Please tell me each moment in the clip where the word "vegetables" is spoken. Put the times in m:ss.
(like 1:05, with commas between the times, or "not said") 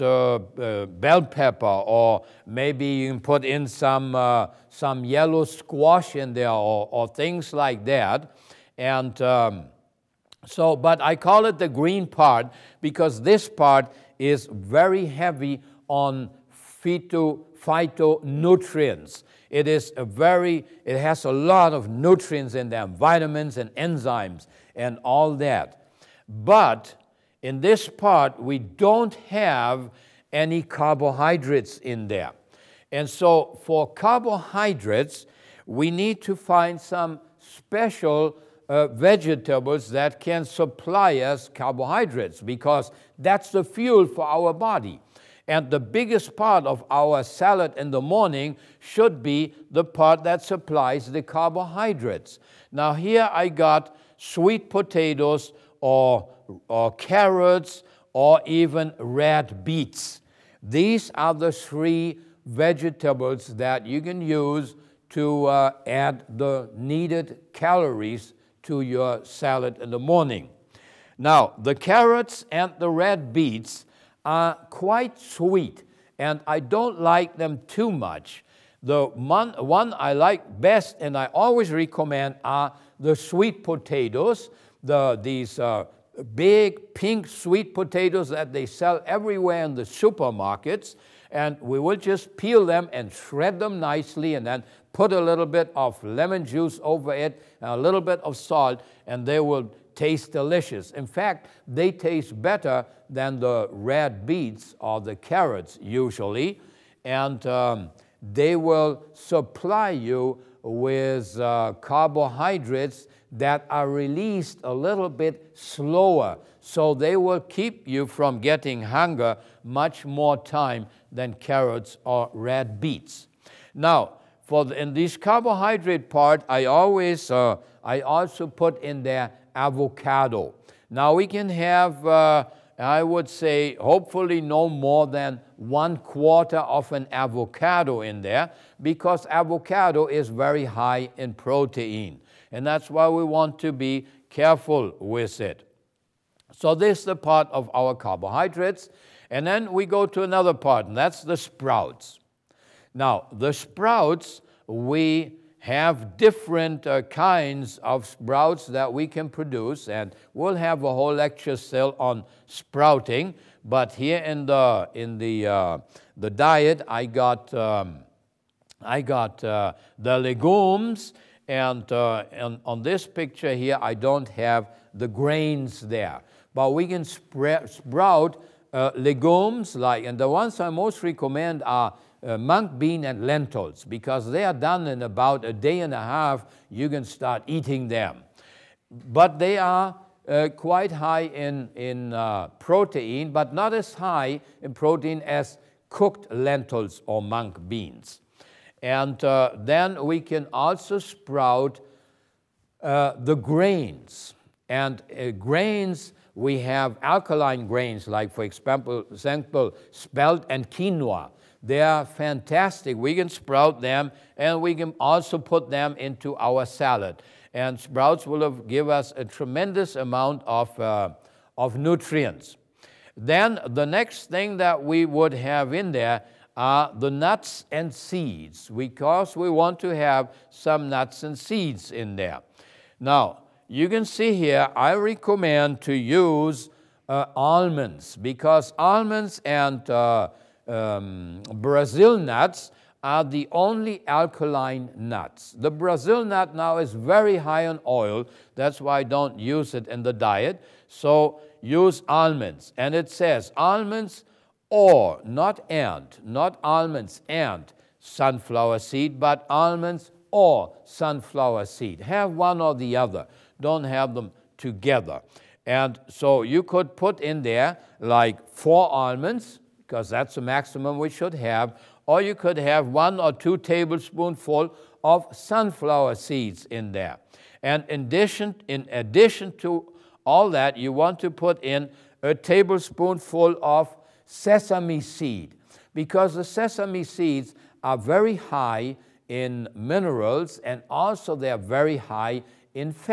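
0:38, 1:02.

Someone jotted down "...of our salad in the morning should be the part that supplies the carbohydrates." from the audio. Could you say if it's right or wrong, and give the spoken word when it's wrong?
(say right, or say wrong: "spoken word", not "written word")
right.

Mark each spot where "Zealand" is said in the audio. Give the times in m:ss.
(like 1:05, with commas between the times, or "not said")
not said.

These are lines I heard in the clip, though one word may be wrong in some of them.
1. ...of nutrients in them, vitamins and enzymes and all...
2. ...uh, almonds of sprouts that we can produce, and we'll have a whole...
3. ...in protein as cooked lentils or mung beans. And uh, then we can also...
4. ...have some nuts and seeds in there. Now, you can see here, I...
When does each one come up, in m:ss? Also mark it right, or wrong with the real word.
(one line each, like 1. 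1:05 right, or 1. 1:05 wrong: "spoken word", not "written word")
1. 0:21 right
2. 2:36 wrong: "kinds", not "almonds"
3. 3:14 right
4. 3:49 right.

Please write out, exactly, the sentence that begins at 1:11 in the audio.
Now, the carrots and the red beets are quite sweet, and I don't like them too much.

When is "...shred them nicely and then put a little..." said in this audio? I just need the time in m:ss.
1:33.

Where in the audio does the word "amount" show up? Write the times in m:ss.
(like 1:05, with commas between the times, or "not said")
3:39.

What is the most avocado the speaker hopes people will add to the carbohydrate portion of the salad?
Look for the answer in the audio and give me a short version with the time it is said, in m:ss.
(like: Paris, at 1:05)
One quarter, at 2:15.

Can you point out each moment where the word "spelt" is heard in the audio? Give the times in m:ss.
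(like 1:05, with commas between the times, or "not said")
3:29.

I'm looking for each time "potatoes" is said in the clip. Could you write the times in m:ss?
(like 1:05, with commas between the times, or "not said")
0:54, 1:23, 1:27.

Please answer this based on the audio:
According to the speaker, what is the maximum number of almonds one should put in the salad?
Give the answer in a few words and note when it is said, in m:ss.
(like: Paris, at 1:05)
4, at 4:28.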